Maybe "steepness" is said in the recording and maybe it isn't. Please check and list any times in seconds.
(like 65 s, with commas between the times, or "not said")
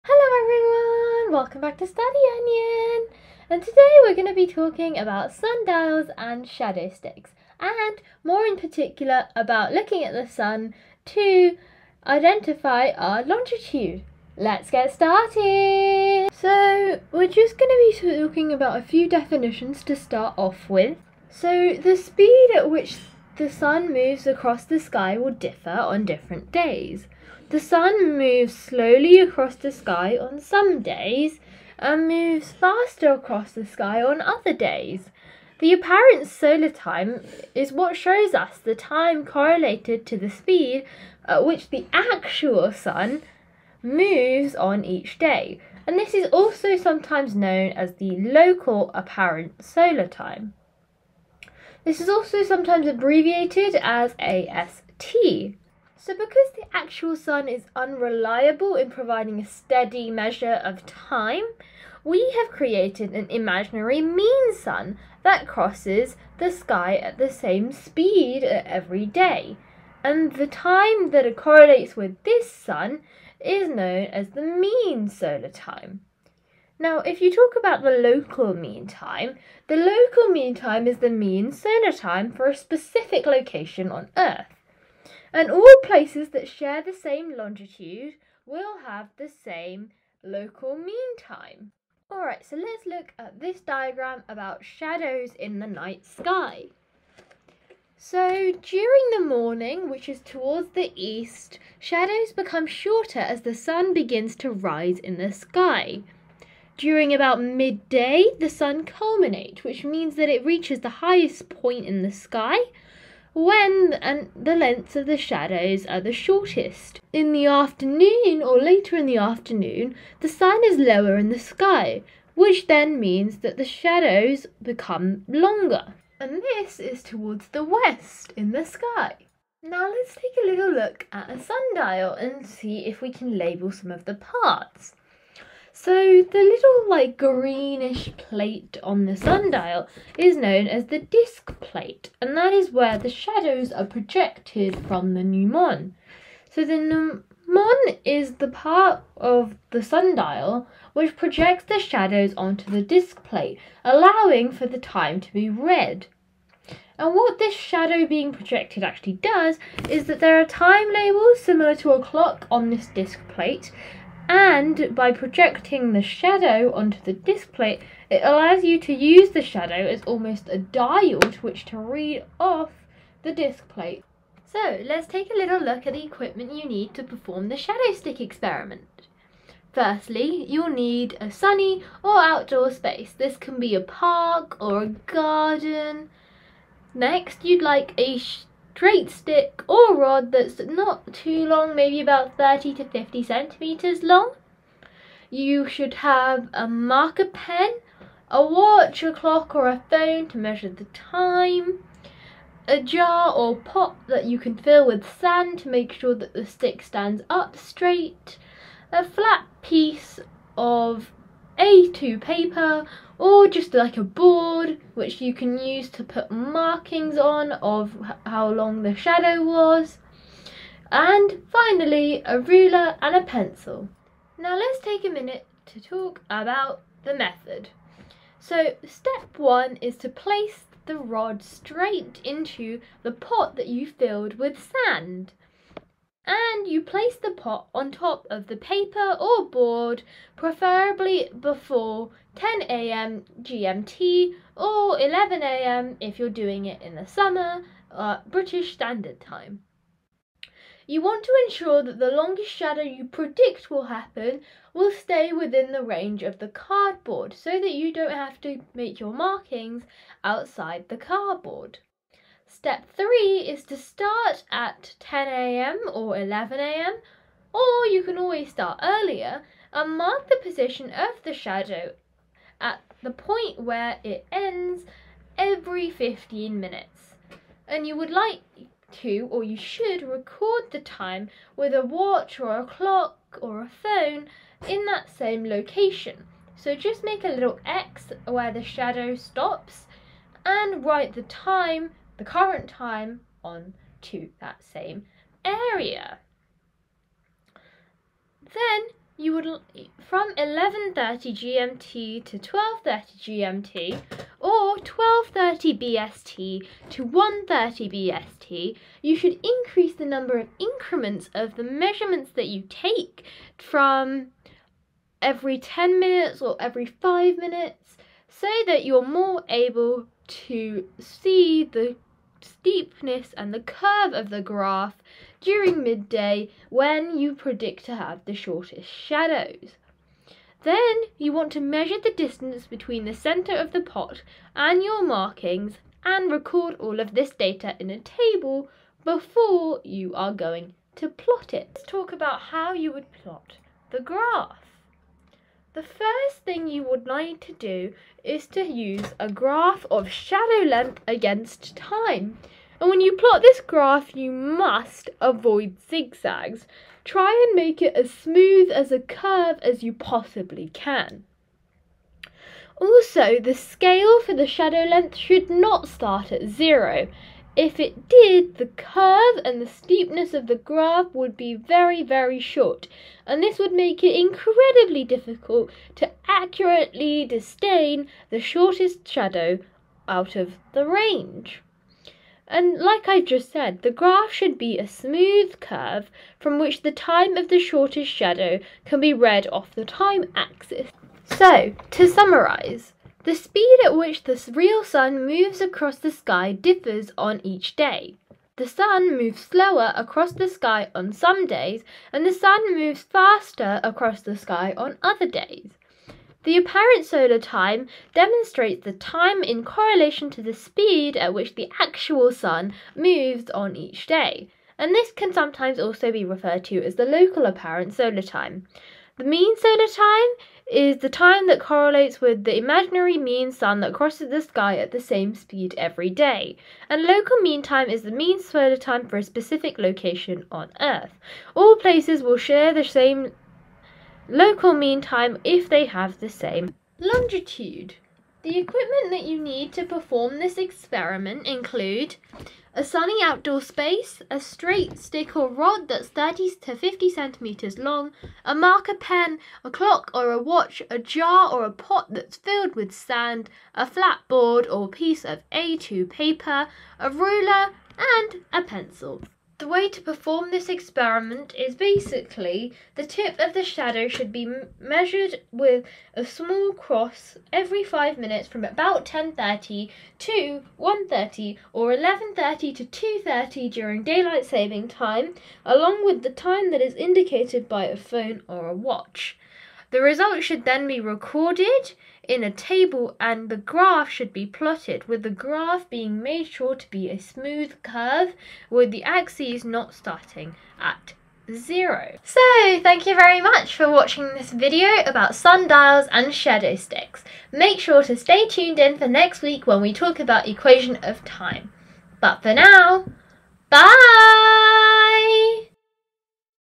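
322 s, 369 s.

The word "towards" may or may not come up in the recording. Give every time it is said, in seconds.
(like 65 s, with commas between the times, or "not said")
100 s, 127 s.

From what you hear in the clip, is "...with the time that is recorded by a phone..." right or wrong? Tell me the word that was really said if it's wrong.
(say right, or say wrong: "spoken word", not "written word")
wrong: "indicated", not "recorded".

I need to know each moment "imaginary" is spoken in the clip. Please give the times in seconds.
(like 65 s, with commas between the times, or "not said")
63 s, 422 s.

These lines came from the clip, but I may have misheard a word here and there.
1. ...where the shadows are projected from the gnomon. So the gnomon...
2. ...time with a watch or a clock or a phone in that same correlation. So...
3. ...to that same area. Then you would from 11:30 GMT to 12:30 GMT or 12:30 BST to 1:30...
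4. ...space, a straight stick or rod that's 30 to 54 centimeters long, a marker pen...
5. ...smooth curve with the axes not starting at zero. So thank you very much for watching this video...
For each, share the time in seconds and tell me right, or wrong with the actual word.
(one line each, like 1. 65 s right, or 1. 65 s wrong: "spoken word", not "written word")
1. 142 s right
2. 280 s wrong: "location", not "correlation"
3. 293 s right
4. 443 s wrong: "50", not "54"
5. 487 s right.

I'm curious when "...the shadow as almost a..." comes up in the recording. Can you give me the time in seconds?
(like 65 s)
169 s.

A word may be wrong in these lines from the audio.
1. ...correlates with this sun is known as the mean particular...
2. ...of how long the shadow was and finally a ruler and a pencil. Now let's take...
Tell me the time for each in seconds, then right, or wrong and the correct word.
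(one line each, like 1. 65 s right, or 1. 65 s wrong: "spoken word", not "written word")
1. 71 s wrong: "solar", not "particular"
2. 217 s right.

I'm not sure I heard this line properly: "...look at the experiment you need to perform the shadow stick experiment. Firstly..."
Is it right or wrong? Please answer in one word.
wrong.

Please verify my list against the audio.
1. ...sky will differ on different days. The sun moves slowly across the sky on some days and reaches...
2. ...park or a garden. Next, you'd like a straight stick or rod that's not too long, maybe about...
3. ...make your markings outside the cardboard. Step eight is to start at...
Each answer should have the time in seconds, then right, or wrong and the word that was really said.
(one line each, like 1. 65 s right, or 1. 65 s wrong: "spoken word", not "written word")
1. 24 s wrong: "moves", not "reaches"
2. 183 s right
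3. 258 s wrong: "three", not "eight".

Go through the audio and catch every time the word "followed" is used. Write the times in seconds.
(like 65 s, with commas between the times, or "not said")
not said.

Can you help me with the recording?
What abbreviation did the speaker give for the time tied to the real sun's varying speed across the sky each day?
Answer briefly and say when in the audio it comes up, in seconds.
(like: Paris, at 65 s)
AST, at 54 s.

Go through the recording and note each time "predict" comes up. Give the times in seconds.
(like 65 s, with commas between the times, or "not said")
253 s, 327 s.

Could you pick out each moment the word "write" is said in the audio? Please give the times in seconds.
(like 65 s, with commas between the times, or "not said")
290 s.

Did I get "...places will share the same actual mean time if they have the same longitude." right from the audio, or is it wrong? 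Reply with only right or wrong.
wrong.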